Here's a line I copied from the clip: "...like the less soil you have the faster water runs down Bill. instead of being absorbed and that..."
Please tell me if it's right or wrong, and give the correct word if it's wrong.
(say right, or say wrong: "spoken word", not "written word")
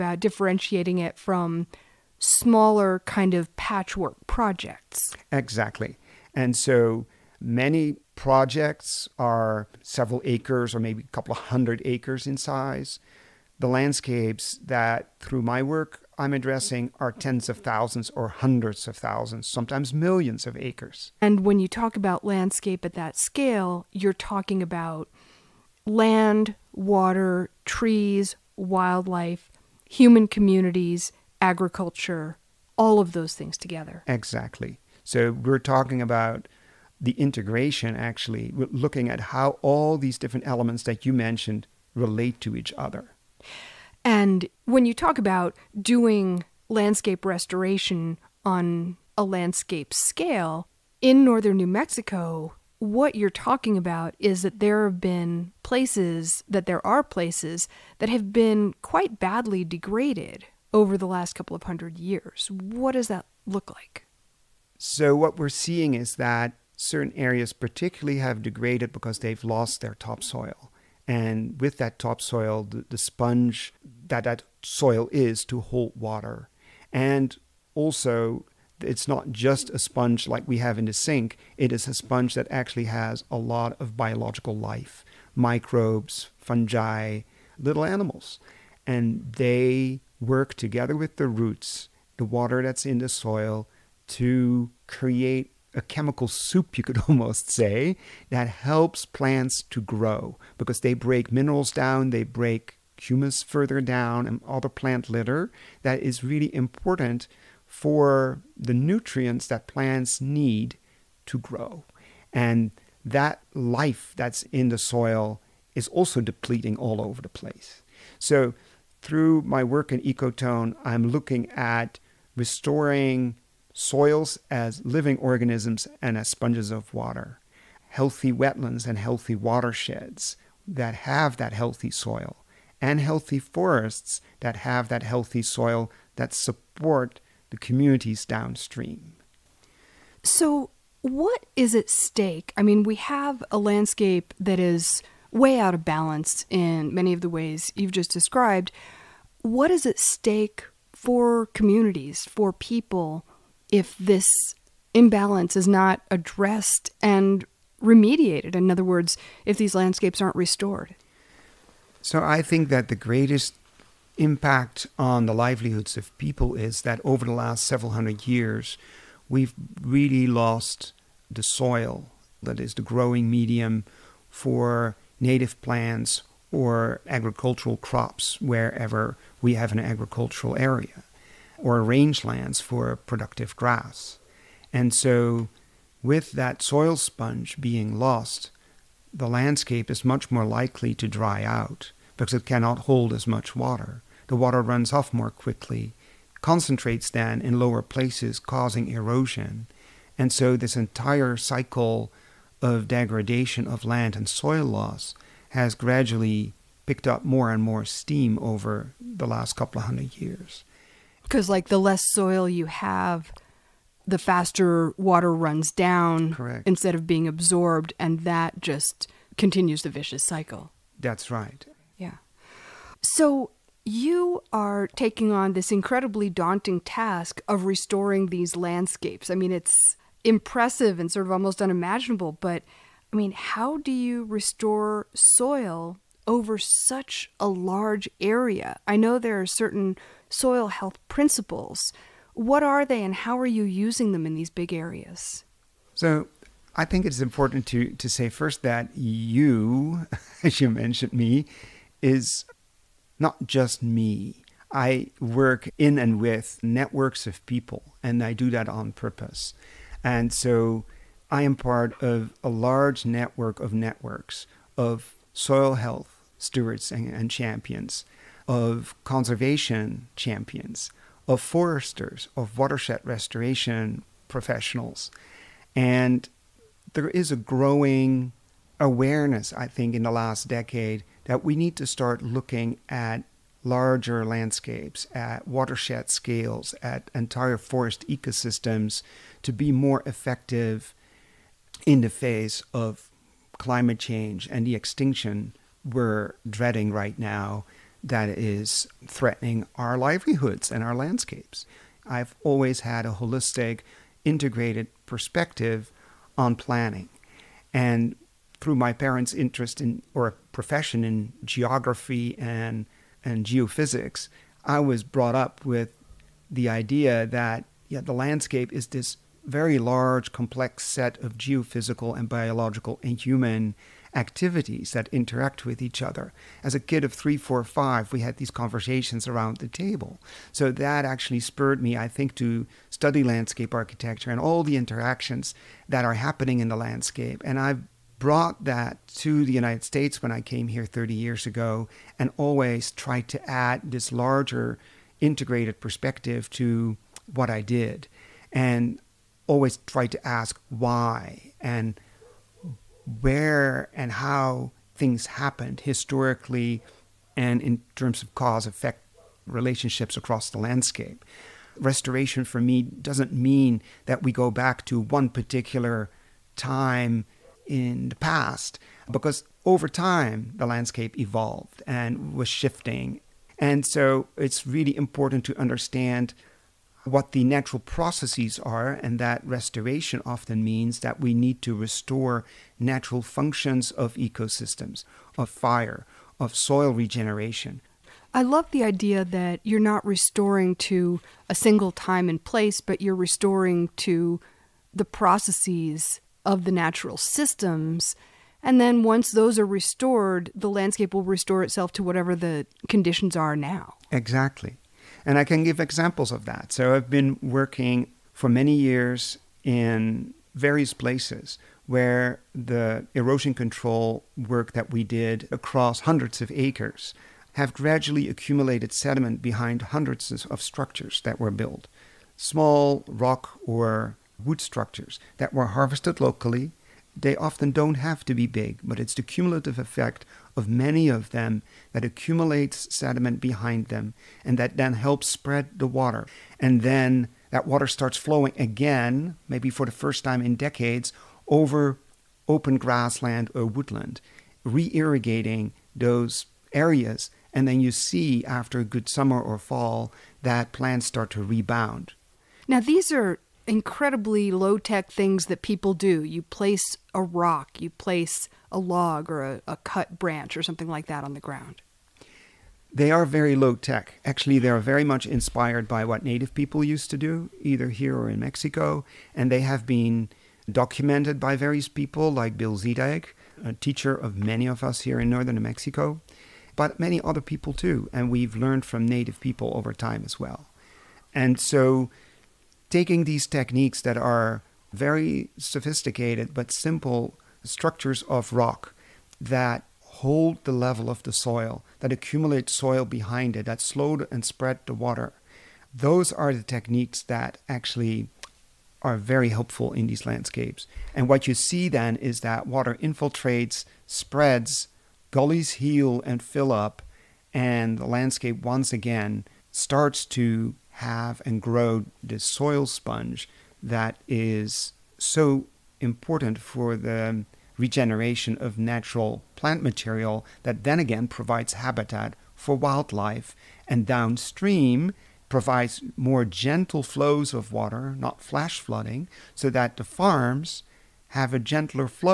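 wrong: "Correct", not "Bill".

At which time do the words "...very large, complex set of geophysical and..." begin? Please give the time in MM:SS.
05:19.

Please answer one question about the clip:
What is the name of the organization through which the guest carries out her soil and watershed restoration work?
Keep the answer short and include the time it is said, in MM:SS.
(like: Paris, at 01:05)
Ecotone, at 02:00.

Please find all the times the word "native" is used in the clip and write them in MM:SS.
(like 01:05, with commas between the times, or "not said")
02:55, 07:46, 07:59.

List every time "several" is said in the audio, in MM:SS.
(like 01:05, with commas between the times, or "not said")
00:09, 02:47.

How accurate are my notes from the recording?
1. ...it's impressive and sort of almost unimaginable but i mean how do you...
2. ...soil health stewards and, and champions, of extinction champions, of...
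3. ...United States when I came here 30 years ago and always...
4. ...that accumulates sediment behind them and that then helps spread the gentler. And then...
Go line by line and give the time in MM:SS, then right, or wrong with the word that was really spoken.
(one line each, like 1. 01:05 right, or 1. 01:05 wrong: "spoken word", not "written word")
1. 03:49 right
2. 04:25 wrong: "conservation", not "extinction"
3. 05:39 right
4. 07:11 wrong: "water", not "gentler".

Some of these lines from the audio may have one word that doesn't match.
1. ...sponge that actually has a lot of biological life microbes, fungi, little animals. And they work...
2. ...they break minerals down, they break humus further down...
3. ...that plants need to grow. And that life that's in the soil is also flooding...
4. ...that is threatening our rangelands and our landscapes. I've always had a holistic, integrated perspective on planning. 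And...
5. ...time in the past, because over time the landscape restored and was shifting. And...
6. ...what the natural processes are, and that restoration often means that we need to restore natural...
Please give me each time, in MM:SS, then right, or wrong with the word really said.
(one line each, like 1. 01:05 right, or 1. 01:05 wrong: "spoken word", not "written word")
1. 01:21 right
2. 01:40 right
3. 01:49 wrong: "depleting", not "flooding"
4. 04:58 wrong: "livelihoods", not "rangelands"
5. 06:06 wrong: "evolved", not "restored"
6. 06:17 right.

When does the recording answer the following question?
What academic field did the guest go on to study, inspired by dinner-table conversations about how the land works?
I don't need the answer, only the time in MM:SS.
05:33.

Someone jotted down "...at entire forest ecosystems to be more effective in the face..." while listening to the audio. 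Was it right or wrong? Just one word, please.
right.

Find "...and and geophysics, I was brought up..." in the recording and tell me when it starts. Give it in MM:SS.
05:12.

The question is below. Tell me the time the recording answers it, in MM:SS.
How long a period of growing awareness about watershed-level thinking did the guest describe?
04:39.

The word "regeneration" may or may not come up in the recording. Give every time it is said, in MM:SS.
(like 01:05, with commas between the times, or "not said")
06:26, 08:37.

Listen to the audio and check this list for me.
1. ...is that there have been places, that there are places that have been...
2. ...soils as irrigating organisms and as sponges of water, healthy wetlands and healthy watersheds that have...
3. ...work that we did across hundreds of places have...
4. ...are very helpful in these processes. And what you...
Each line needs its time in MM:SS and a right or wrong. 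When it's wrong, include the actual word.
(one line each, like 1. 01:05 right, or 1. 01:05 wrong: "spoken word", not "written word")
1. 00:54 right
2. 02:03 wrong: "living", not "irrigating"
3. 06:54 wrong: "acres", not "places"
4. 08:19 wrong: "landscapes", not "processes".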